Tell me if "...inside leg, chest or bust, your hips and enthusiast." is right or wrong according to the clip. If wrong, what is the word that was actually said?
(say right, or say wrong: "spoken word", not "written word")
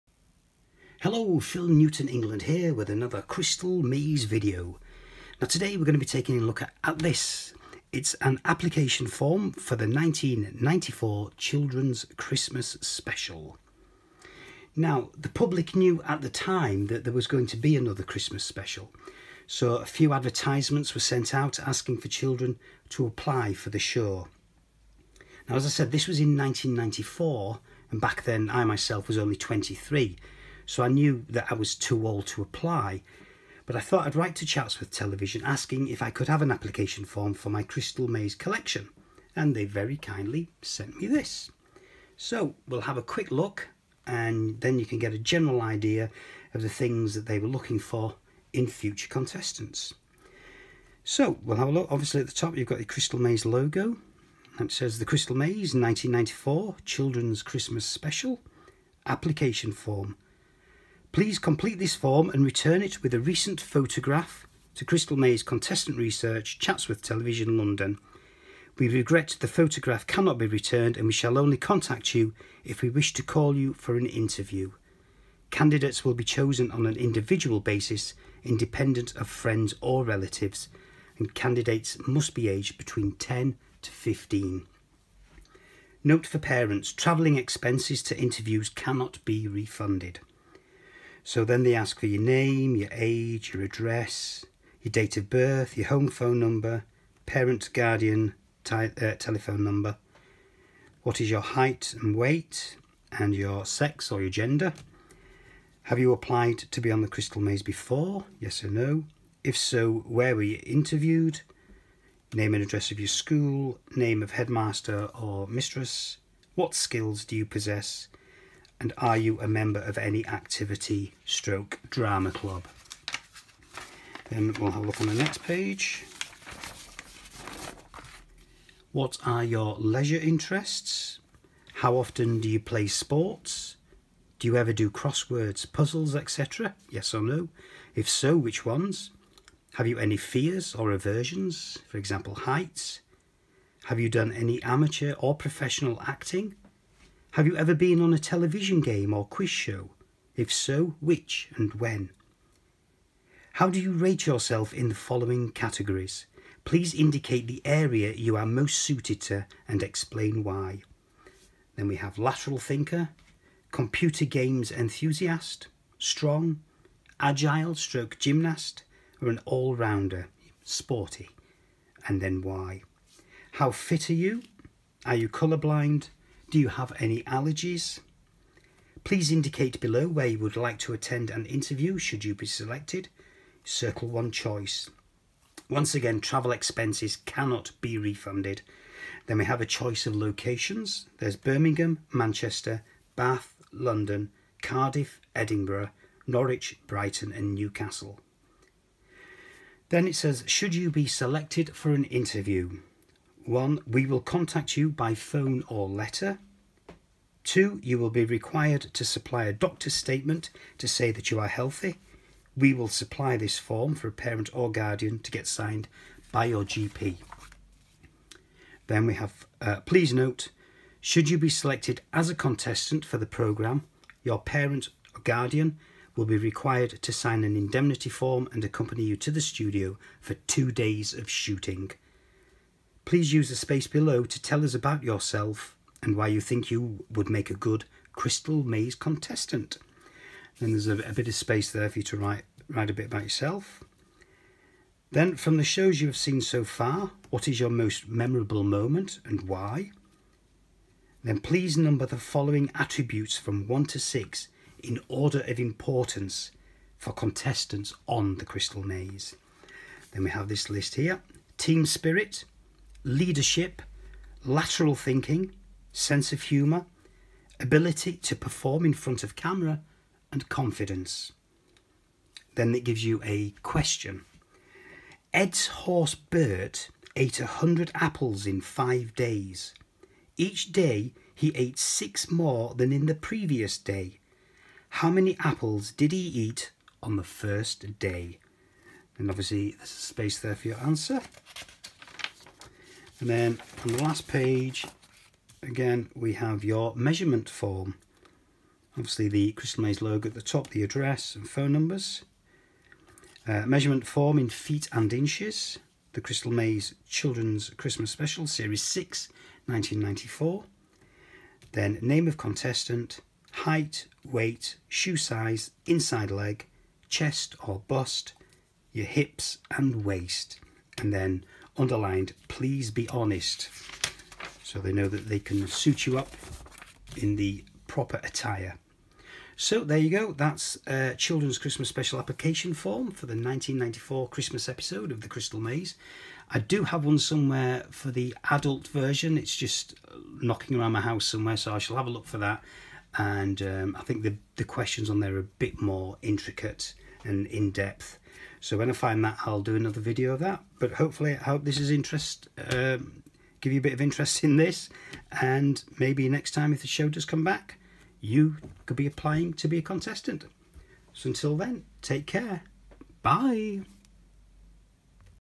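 wrong: "waist", not "enthusiast".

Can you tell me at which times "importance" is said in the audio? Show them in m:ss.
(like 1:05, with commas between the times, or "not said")
4:15.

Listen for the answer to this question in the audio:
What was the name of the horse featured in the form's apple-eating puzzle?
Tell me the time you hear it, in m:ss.
4:36.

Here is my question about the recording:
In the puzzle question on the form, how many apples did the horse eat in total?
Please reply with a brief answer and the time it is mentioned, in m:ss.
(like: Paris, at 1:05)
100, at 4:37.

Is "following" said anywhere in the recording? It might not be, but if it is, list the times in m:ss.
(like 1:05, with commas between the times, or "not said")
2:34, 4:12.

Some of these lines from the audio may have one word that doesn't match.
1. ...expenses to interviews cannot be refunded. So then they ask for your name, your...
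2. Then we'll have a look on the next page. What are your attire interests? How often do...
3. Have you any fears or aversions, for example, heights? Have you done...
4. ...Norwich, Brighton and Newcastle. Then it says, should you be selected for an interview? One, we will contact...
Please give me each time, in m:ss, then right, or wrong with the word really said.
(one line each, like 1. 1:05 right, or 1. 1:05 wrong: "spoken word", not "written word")
1. 1:27 right
2. 2:04 wrong: "leisure", not "attire"
3. 2:19 right
4. 3:16 right.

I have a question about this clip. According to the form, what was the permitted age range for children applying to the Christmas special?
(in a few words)
10 to 15.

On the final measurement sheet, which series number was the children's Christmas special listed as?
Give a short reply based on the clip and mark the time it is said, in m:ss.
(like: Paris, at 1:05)
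Series 6, at 5:08.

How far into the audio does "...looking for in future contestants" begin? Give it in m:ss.
0:47.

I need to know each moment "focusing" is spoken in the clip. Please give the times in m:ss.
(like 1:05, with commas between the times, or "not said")
not said.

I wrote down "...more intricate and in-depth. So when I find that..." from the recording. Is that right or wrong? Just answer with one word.
right.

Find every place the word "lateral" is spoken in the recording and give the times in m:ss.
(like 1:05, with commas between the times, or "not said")
2:42, 4:24.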